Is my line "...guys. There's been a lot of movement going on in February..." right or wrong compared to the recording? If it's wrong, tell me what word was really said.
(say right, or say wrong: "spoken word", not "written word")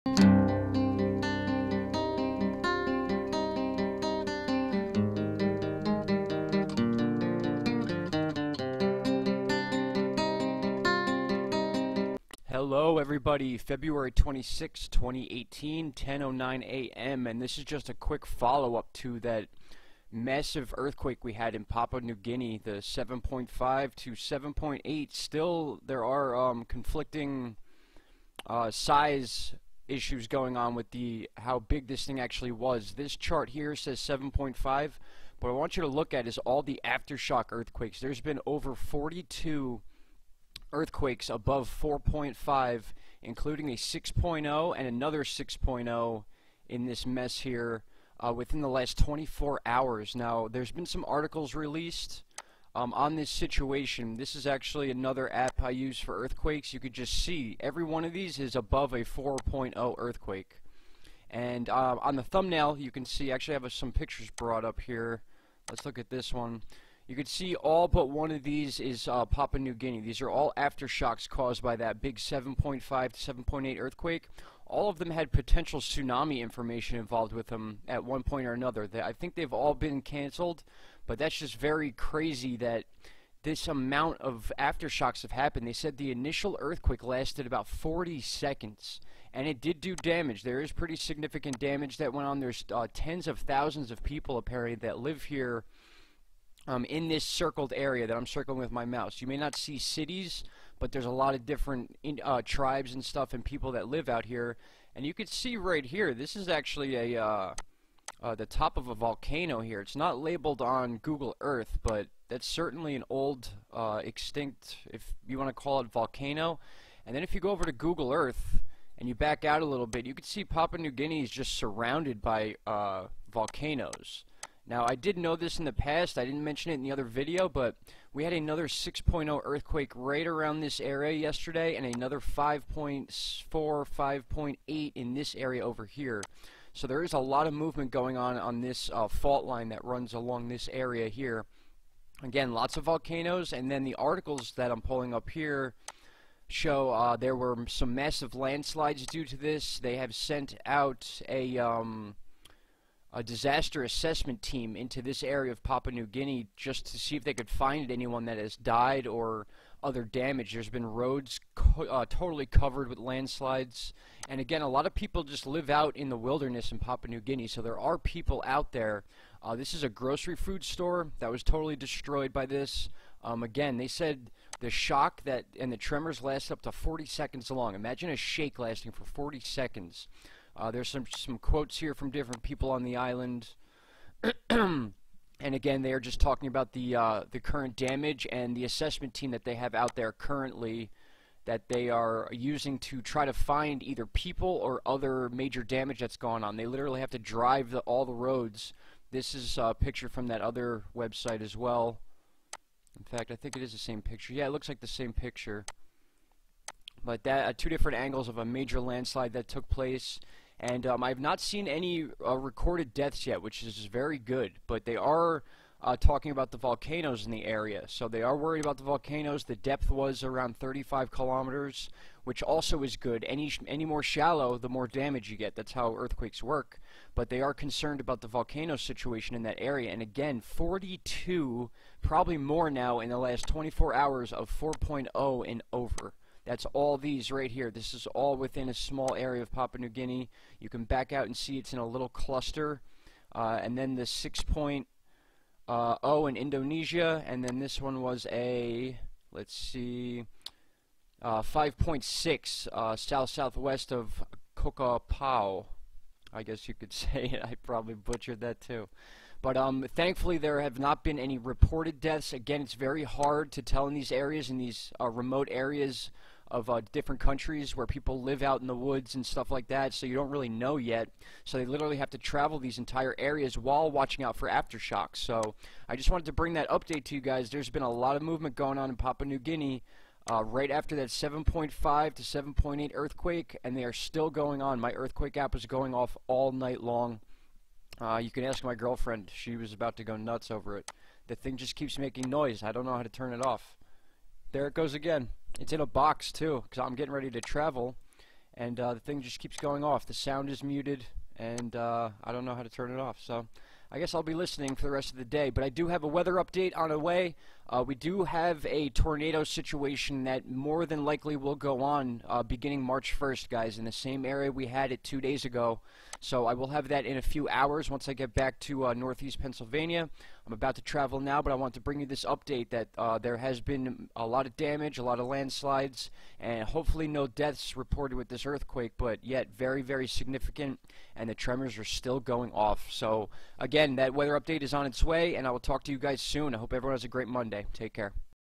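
wrong: "Papua", not "February".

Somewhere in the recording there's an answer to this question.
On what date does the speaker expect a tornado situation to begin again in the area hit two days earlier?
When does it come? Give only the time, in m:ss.
5:12.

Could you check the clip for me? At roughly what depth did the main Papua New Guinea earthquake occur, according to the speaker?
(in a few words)
35 kilometers.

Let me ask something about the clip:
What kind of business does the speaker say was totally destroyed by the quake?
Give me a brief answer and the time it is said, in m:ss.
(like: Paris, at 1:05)
grocery food store, at 2:49.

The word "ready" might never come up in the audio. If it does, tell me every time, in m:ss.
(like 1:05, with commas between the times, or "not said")
4:57.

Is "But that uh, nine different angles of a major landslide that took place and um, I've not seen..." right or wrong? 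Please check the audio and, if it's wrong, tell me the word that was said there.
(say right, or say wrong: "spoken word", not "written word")
wrong: "two", not "nine".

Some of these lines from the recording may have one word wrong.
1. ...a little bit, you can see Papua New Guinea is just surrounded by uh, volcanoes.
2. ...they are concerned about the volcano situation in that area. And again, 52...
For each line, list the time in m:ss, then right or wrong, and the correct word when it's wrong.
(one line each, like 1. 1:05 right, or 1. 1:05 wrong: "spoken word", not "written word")
1. 1:59 right
2. 3:47 wrong: "42", not "52".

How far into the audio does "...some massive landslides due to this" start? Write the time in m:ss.
2:27.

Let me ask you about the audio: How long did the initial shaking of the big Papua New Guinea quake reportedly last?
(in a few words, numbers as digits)
40 seconds.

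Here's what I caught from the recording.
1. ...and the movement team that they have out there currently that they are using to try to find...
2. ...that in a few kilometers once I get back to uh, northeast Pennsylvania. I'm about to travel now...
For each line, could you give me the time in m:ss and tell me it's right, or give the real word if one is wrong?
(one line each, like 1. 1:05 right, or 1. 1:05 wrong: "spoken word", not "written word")
1. 3:08 wrong: "assessment", not "movement"
2. 5:16 wrong: "hours", not "kilometers".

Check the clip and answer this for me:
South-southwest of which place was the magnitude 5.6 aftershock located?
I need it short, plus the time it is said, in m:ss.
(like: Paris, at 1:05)
Kokopau, at 4:14.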